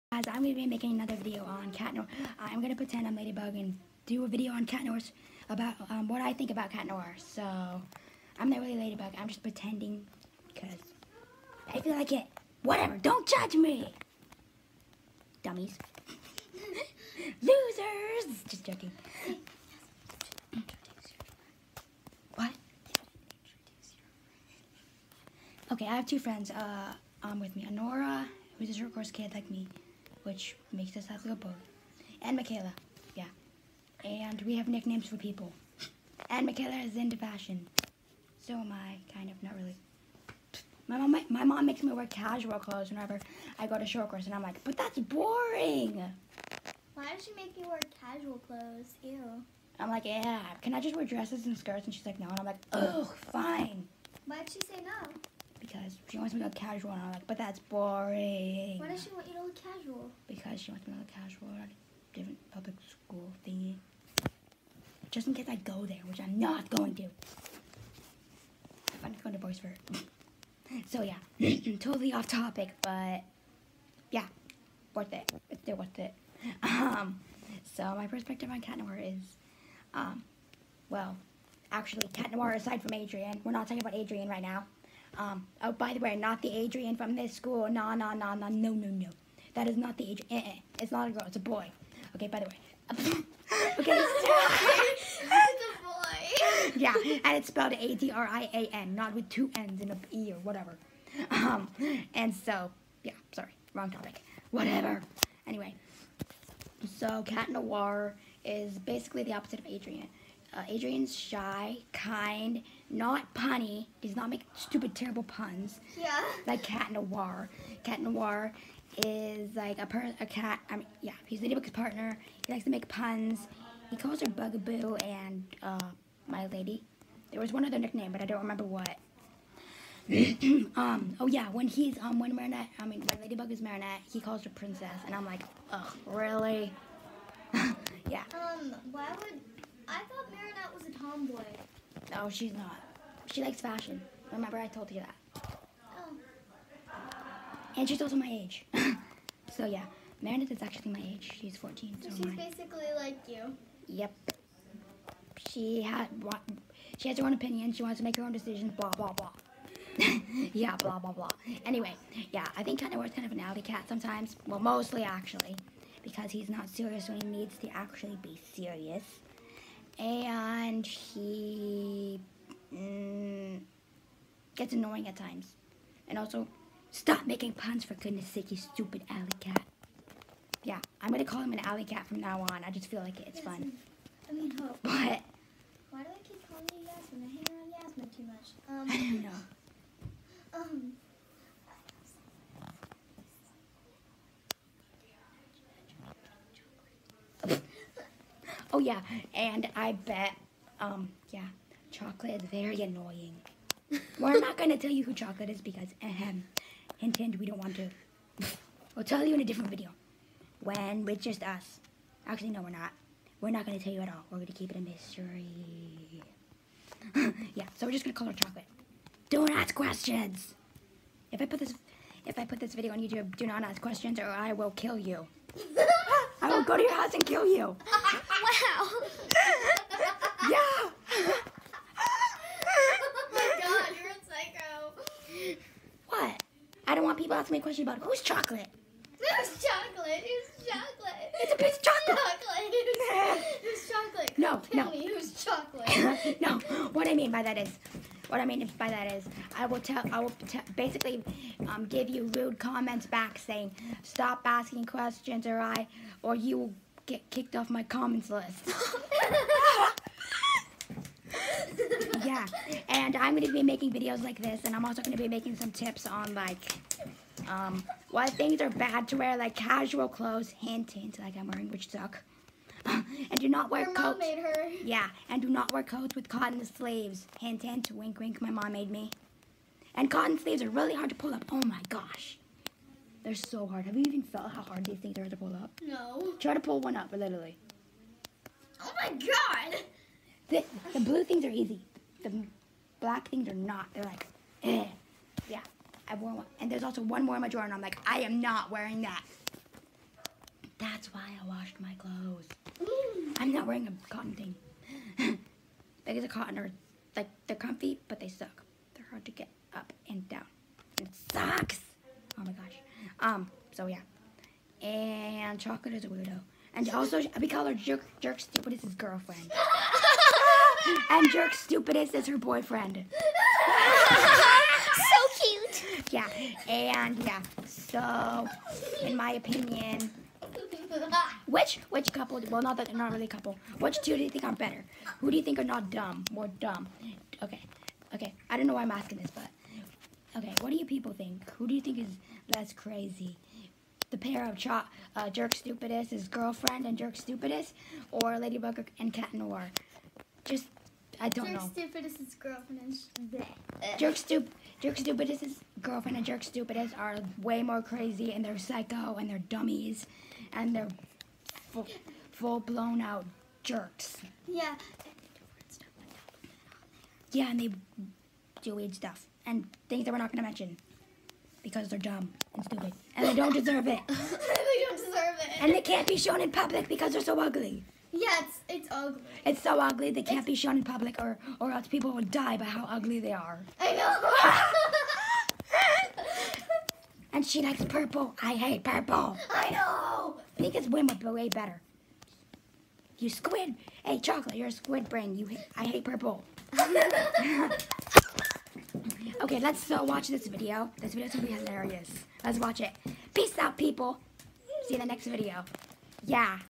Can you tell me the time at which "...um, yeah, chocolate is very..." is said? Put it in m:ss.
3:20.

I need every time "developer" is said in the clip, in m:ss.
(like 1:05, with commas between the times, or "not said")
not said.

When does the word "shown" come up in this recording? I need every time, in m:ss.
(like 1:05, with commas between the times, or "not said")
6:16, 6:20.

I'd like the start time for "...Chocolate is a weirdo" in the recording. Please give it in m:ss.
5:15.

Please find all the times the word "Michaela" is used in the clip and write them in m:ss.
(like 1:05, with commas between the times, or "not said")
0:32, 0:36.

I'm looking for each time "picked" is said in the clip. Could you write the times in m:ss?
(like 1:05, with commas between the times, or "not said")
not said.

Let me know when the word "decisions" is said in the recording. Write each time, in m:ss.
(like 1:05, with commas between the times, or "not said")
2:38.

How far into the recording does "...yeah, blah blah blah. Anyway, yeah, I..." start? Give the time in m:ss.
2:40.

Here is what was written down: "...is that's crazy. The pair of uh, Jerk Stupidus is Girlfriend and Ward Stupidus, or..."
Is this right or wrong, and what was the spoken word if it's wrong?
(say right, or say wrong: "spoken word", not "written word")
wrong: "Jerk", not "Ward".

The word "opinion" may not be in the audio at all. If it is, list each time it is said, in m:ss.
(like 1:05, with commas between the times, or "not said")
2:37, 5:29.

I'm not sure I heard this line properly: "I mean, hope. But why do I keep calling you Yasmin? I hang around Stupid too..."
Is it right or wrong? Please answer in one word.
wrong.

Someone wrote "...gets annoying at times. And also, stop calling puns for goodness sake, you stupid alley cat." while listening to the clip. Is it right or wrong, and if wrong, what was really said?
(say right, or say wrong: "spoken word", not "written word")
wrong: "making", not "calling".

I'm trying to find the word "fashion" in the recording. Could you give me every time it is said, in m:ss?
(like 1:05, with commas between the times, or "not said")
0:37, 2:23.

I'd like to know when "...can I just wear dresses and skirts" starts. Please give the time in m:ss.
0:50.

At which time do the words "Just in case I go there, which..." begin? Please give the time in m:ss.
1:05.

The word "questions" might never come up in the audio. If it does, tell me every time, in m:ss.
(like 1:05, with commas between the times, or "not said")
3:39, 3:43, 3:57, 4:14.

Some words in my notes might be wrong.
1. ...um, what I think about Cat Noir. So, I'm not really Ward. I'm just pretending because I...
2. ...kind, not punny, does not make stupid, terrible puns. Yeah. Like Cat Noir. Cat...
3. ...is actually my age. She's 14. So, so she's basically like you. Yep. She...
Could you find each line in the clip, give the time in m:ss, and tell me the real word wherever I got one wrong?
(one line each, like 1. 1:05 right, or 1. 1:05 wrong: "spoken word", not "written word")
1. 0:05 wrong: "Ladybug", not "Ward"
2. 1:51 right
3. 2:30 right.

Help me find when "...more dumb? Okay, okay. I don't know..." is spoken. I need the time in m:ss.
5:36.